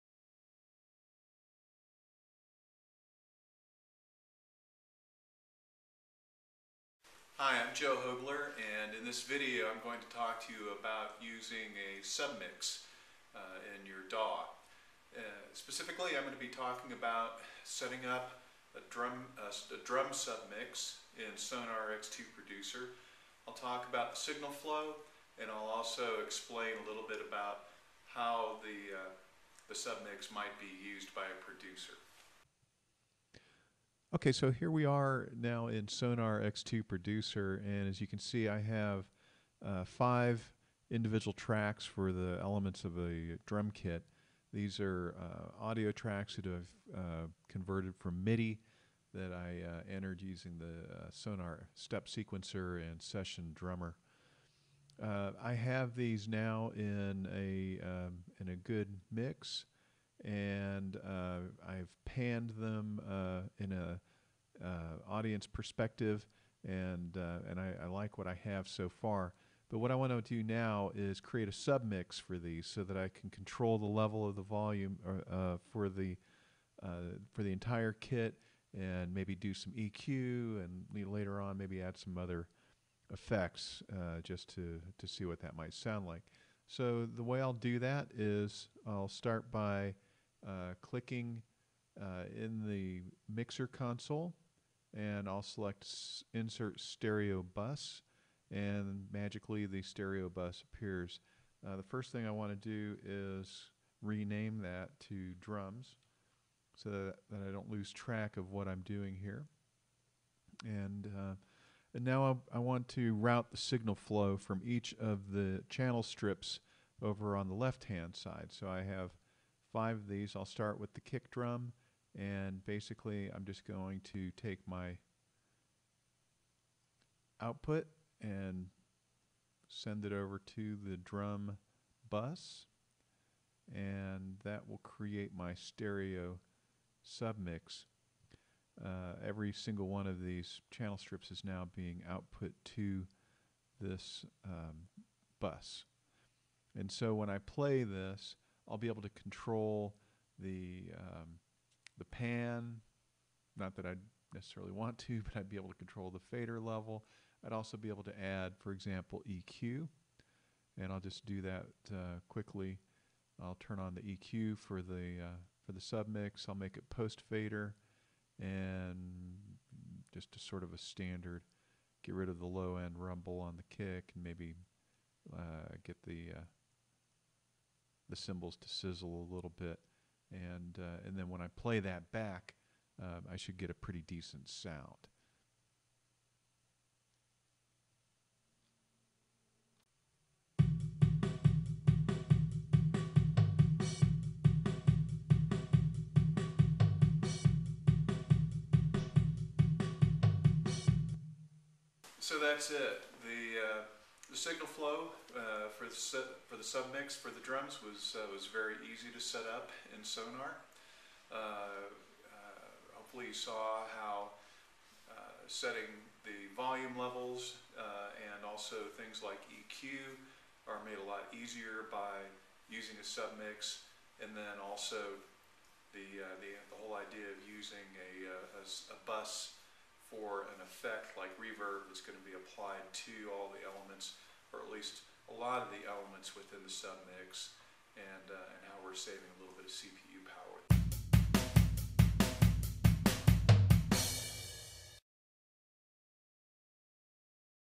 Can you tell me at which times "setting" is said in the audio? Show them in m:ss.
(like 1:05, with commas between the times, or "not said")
0:17, 3:35.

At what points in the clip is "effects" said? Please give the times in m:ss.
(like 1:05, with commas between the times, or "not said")
1:23, 3:50.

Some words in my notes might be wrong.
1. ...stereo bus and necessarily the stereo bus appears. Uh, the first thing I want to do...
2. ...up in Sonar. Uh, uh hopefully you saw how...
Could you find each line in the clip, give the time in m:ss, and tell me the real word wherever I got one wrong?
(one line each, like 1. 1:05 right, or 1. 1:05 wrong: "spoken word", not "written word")
1. 1:36 wrong: "magically", not "necessarily"
2. 3:29 right.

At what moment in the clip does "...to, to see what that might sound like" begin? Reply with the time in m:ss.
1:24.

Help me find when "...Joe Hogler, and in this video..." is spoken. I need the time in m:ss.
0:07.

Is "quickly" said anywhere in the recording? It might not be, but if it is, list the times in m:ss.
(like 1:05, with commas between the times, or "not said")
2:42.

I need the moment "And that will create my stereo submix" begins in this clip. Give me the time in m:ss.
2:13.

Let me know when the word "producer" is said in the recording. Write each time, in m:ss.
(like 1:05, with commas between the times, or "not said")
0:22, 0:31, 0:36.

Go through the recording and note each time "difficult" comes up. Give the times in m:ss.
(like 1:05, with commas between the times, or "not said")
not said.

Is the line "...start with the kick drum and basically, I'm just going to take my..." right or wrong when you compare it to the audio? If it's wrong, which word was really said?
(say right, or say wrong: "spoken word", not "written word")
right.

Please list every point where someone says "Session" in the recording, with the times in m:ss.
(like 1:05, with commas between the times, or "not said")
0:53.